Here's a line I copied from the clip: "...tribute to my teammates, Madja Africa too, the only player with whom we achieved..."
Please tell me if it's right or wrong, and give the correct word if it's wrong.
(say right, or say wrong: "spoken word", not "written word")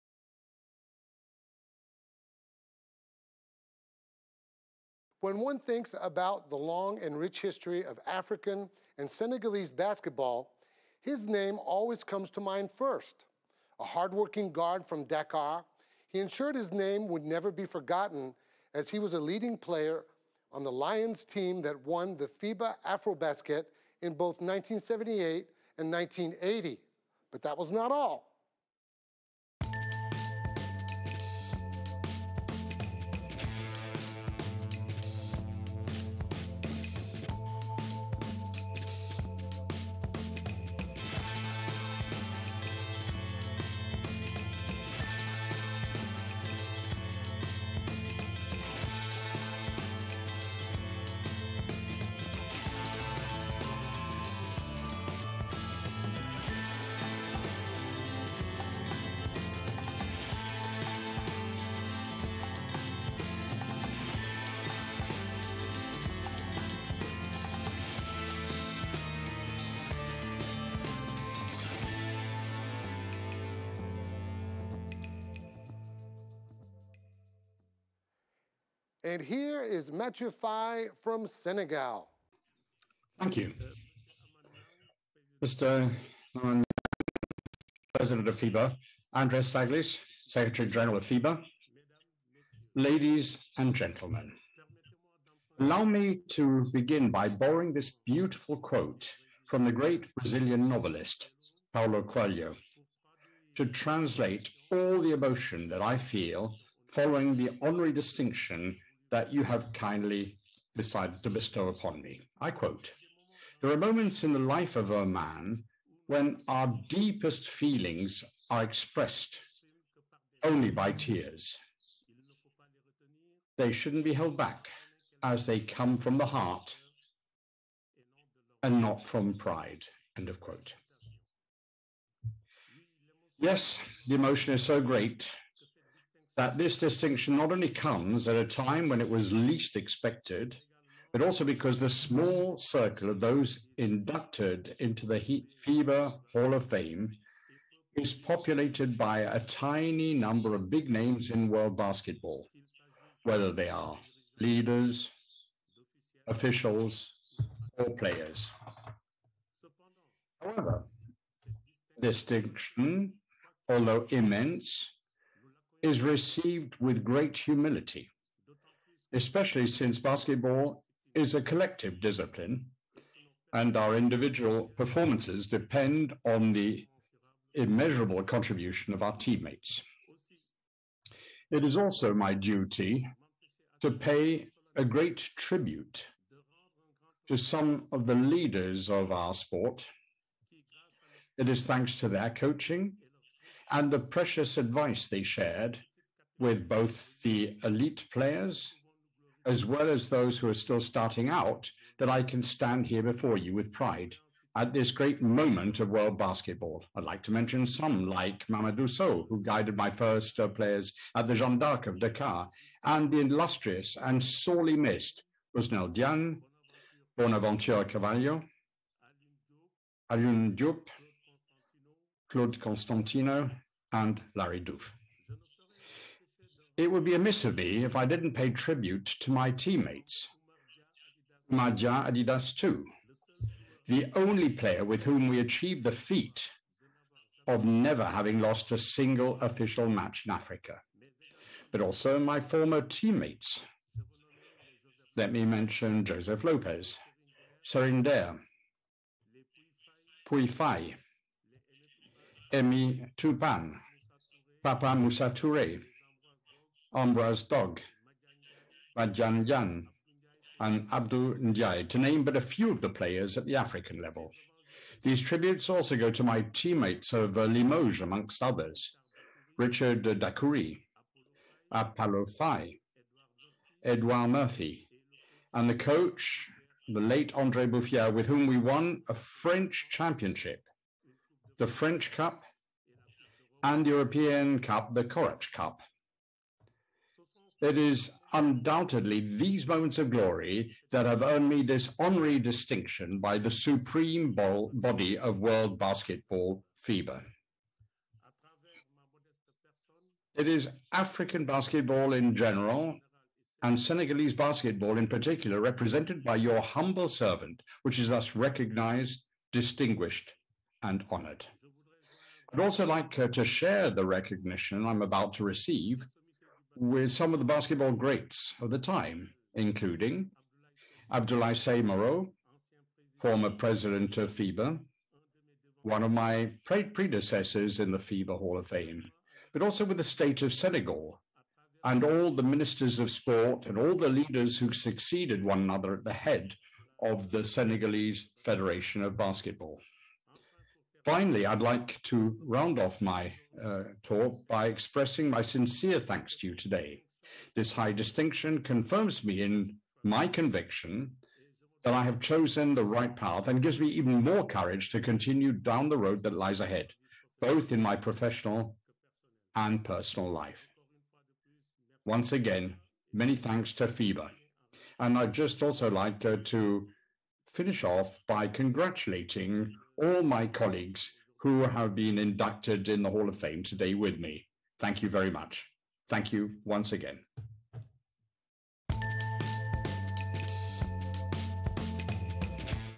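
wrong: "Adidas", not "Africa".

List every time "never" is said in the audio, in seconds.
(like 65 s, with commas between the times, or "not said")
17 s, 237 s.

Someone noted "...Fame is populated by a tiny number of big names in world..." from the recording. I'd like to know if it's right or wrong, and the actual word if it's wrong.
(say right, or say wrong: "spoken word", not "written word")
right.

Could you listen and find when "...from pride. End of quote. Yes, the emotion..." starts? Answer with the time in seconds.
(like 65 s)
129 s.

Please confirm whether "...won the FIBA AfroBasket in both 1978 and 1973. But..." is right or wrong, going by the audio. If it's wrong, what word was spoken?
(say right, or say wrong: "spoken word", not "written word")
wrong: "1980", not "1973".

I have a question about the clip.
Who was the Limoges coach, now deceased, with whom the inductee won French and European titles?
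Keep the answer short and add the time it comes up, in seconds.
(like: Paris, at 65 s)
Andre Buffière, at 277 s.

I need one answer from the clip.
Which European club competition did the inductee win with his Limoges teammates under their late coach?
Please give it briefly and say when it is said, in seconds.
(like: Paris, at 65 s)
Korac Cup, at 284 s.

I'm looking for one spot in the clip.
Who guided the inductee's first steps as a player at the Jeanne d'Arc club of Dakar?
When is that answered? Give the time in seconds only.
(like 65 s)
208 s.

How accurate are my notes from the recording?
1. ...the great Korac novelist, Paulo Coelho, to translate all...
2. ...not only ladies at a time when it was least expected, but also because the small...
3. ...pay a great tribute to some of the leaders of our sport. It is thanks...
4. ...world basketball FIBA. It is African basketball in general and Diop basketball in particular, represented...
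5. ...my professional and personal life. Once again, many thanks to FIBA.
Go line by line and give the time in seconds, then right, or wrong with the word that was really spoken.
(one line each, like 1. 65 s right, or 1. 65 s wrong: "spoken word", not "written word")
1. 99 s wrong: "Brazilian", not "Korac"
2. 137 s wrong: "comes", not "ladies"
3. 183 s right
4. 295 s wrong: "Senegalese", not "Diop"
5. 357 s right.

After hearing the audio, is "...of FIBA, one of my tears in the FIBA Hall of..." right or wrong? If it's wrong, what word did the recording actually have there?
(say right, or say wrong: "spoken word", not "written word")
wrong: "predecessors", not "tears".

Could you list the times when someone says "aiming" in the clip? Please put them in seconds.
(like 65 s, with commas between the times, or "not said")
not said.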